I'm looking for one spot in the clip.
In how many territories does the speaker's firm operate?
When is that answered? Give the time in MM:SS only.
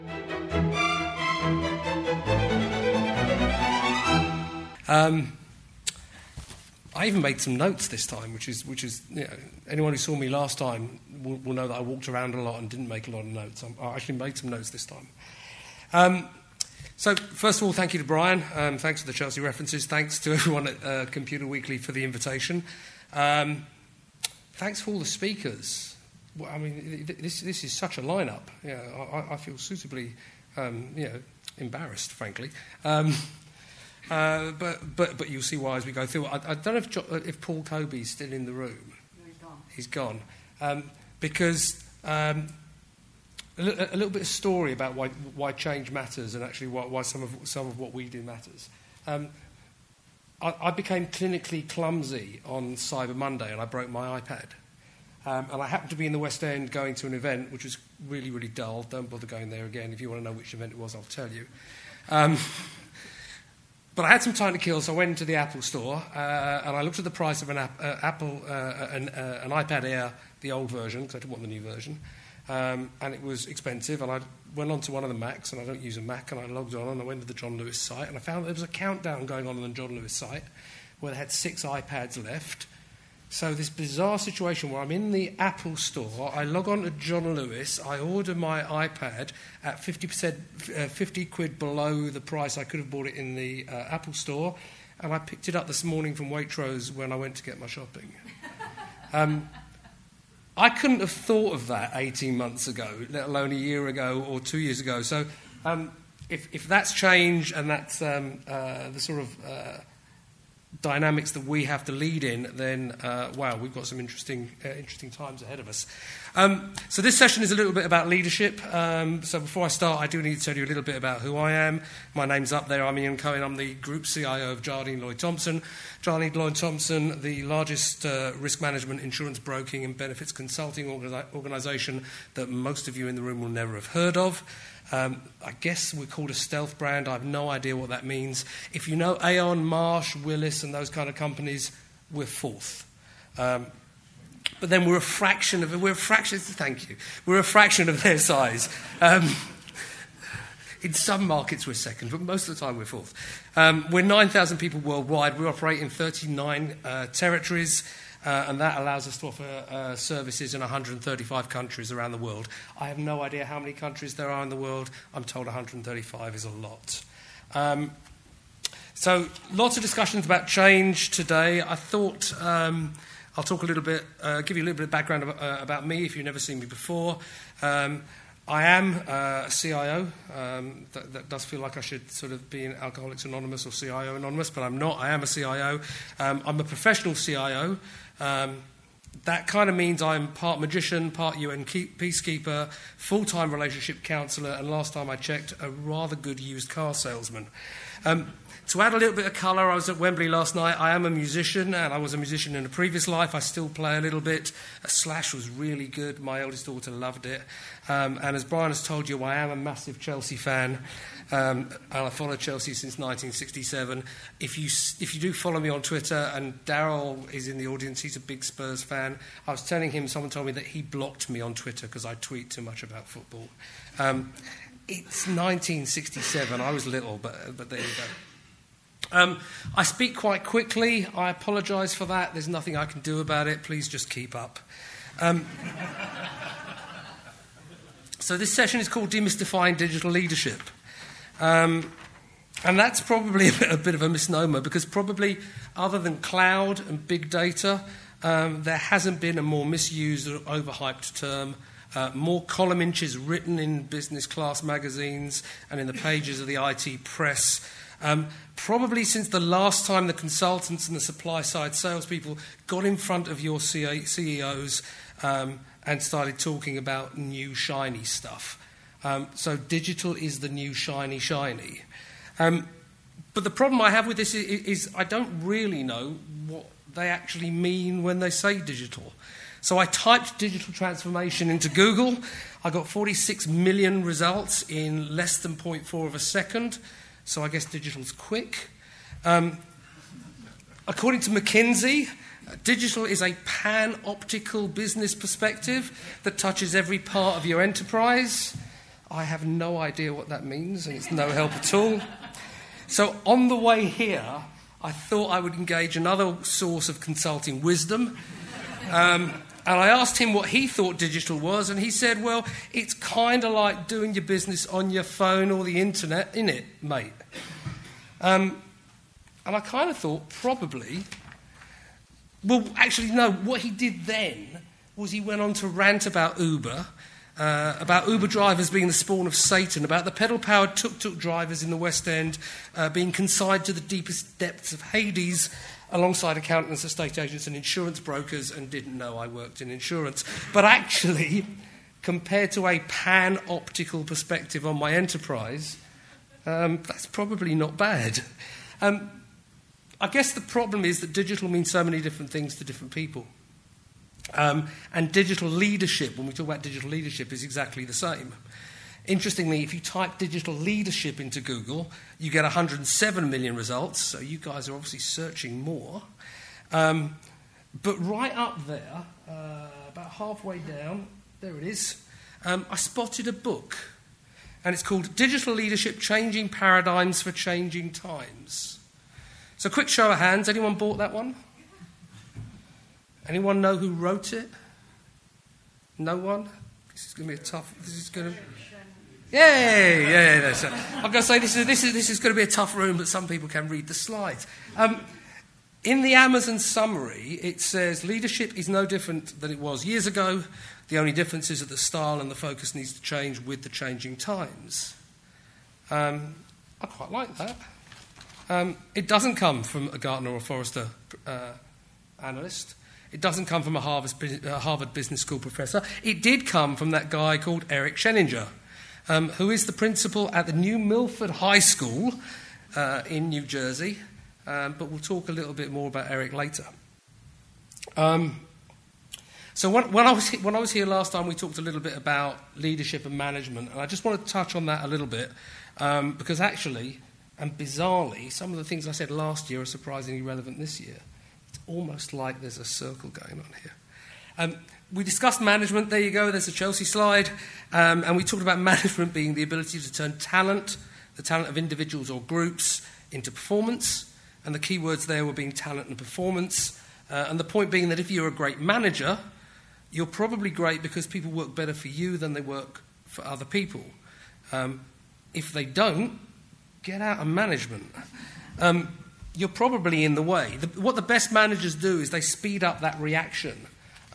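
02:35.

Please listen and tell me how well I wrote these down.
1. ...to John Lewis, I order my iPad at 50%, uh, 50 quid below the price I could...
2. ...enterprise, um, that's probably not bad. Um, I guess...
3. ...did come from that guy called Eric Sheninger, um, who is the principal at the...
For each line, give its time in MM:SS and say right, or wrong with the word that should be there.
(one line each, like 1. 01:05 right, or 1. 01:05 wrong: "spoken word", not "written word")
1. 01:26 right
2. 05:44 right
3. 06:56 right.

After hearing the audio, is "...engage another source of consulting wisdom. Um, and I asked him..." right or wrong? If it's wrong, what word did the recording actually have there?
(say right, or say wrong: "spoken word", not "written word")
right.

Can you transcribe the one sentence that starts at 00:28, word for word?
Yeah, I, I feel suitably um, you know, embarrassed, frankly.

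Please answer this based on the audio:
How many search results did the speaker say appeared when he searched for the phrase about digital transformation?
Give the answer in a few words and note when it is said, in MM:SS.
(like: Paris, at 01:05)
46 million, at 04:42.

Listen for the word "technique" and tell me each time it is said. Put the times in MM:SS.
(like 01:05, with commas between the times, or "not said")
not said.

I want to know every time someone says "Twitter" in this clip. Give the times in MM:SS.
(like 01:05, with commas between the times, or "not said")
03:35, 03:41.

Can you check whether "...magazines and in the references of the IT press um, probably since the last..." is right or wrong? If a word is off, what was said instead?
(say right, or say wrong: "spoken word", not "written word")
wrong: "pages", not "references".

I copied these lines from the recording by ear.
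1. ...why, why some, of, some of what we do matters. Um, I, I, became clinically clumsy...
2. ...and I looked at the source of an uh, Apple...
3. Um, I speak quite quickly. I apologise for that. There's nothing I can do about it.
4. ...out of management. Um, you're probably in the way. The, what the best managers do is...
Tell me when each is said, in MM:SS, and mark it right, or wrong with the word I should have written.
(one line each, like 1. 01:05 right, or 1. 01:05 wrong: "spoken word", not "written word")
1. 00:46 right
2. 01:06 wrong: "price", not "source"
3. 03:49 right
4. 07:47 right.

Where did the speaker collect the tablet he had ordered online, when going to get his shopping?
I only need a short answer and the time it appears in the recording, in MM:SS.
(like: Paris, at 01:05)
Waitrose, at 01:36.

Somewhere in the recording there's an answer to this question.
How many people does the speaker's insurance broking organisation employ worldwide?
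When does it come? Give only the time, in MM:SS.
02:34.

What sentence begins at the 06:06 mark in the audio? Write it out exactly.
Um, but right up there, uh, about halfway down, there it is, um, I spotted a book.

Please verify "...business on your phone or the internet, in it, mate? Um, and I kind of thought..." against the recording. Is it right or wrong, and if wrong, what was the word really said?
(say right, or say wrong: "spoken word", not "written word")
right.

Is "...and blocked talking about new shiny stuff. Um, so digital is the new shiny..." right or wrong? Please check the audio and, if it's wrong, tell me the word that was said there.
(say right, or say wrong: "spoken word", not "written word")
wrong: "started", not "blocked".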